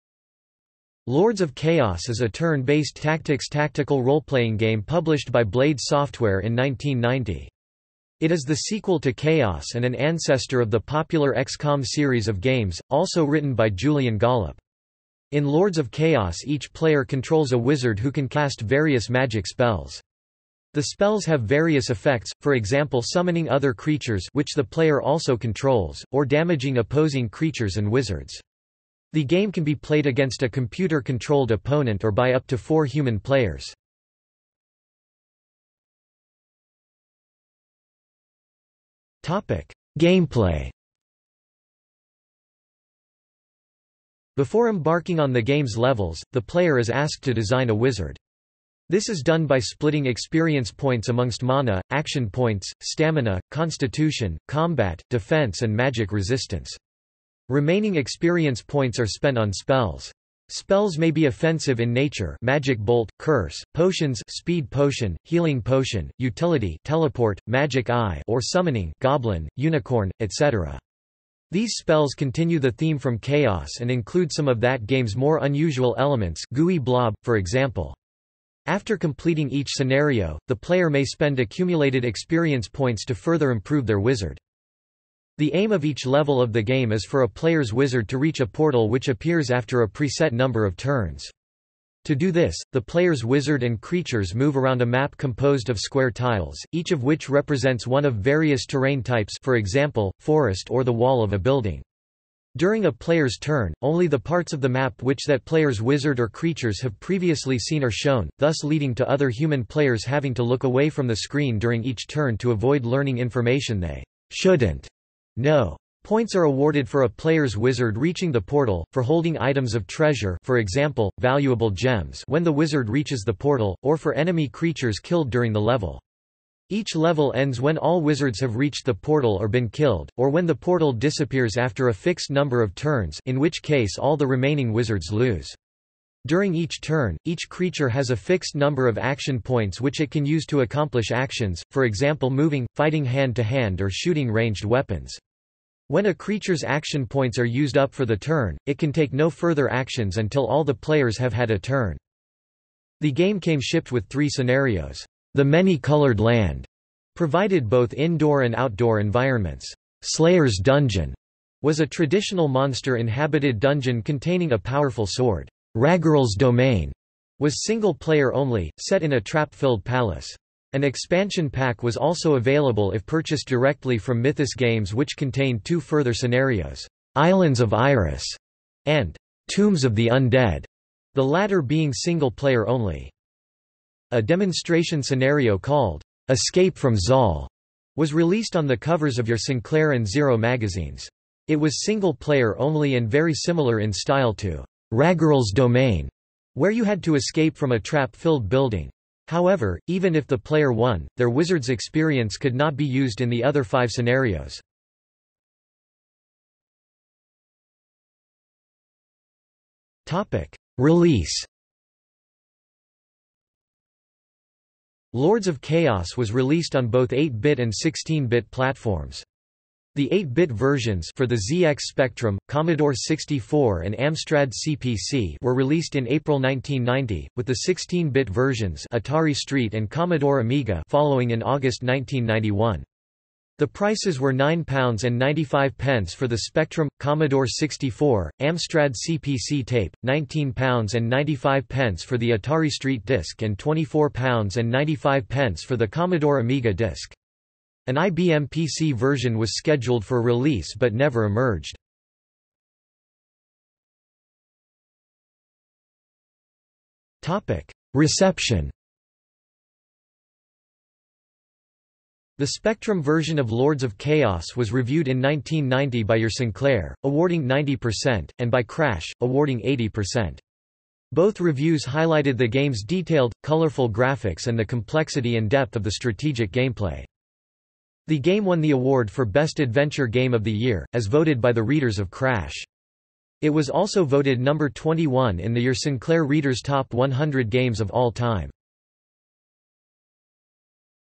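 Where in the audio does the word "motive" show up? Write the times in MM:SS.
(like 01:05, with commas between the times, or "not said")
not said.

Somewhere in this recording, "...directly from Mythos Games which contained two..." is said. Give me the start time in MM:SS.
02:53.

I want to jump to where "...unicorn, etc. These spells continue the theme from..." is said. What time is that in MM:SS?
01:09.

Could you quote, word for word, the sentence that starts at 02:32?
The game came shipped with three scenarios.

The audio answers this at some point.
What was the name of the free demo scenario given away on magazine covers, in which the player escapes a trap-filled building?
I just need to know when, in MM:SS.
03:06.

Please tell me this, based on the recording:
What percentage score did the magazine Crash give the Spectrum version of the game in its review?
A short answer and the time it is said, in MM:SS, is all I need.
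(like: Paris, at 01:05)
80%, at 04:29.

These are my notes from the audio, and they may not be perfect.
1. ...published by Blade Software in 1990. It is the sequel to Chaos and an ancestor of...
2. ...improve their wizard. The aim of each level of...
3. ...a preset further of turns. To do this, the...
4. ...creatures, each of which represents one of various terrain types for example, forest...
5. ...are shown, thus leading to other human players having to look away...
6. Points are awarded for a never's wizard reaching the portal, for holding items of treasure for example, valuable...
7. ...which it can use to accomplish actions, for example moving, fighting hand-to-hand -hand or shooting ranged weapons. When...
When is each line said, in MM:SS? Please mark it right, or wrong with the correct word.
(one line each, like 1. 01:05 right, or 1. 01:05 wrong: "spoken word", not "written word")
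1. 00:04 right
2. 01:23 right
3. 01:29 wrong: "number", not "further"
4. 01:36 wrong: "tiles", not "creatures"
5. 01:47 right
6. 01:56 wrong: "player", not "never"
7. 02:19 right.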